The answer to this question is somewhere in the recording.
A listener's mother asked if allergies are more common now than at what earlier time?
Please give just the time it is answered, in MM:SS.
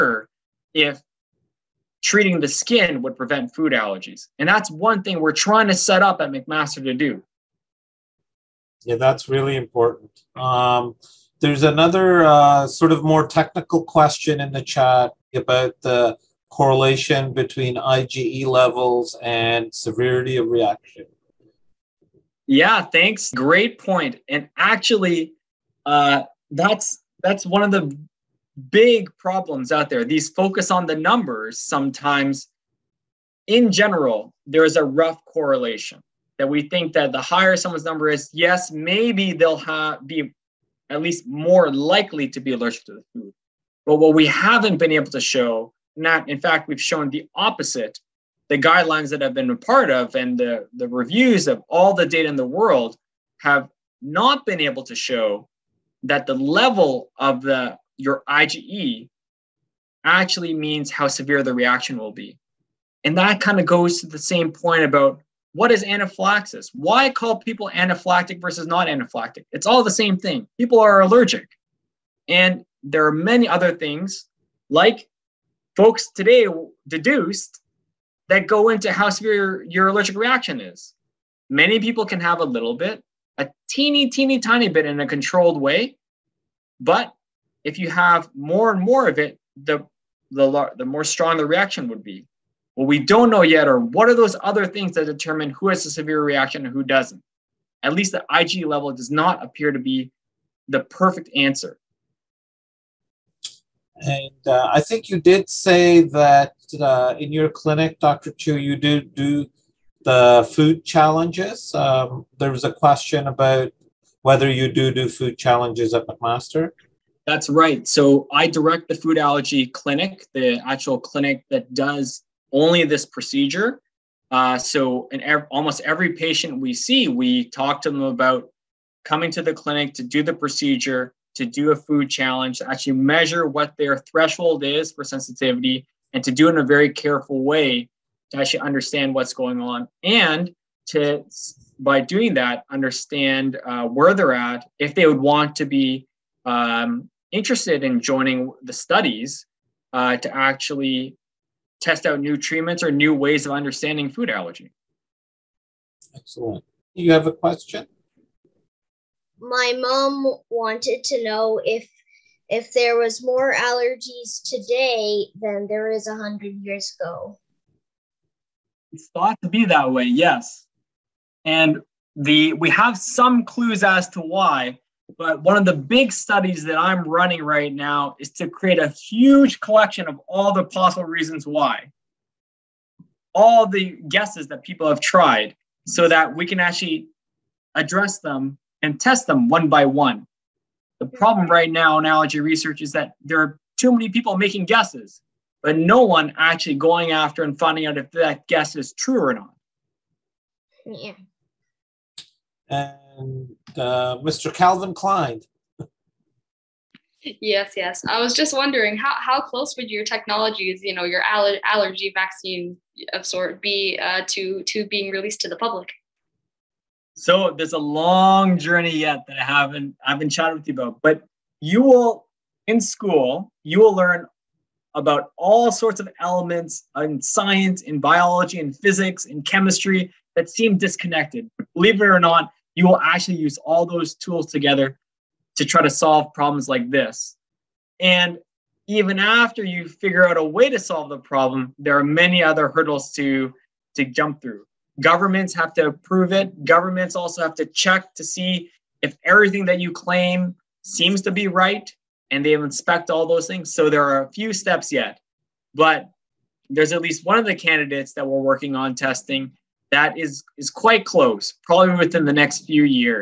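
02:46.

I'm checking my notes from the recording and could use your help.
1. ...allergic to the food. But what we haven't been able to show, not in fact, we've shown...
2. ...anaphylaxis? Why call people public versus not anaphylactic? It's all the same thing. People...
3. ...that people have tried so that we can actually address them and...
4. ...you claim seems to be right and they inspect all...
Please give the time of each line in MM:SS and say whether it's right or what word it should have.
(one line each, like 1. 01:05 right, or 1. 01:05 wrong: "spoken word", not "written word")
1. 00:42 right
2. 01:05 wrong: "anaphylactic", not "public"
3. 03:04 right
4. 04:09 right.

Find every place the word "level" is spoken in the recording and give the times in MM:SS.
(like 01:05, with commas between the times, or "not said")
00:18, 00:56, 01:38.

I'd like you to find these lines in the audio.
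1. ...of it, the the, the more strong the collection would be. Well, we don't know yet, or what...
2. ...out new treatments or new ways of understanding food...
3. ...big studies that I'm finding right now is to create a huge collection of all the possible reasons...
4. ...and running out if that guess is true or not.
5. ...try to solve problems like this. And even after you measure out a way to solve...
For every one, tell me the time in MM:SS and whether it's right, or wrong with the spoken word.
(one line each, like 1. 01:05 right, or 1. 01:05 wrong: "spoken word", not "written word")
1. 01:29 wrong: "reaction", not "collection"
2. 02:32 right
3. 02:55 wrong: "running", not "finding"
4. 03:17 wrong: "finding", not "running"
5. 03:55 wrong: "figure", not "measure".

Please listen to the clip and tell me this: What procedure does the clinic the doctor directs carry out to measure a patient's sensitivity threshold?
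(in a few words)
Food challenge.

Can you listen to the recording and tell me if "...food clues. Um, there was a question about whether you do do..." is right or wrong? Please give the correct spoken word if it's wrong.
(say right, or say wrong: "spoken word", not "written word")
wrong: "challenges", not "clues".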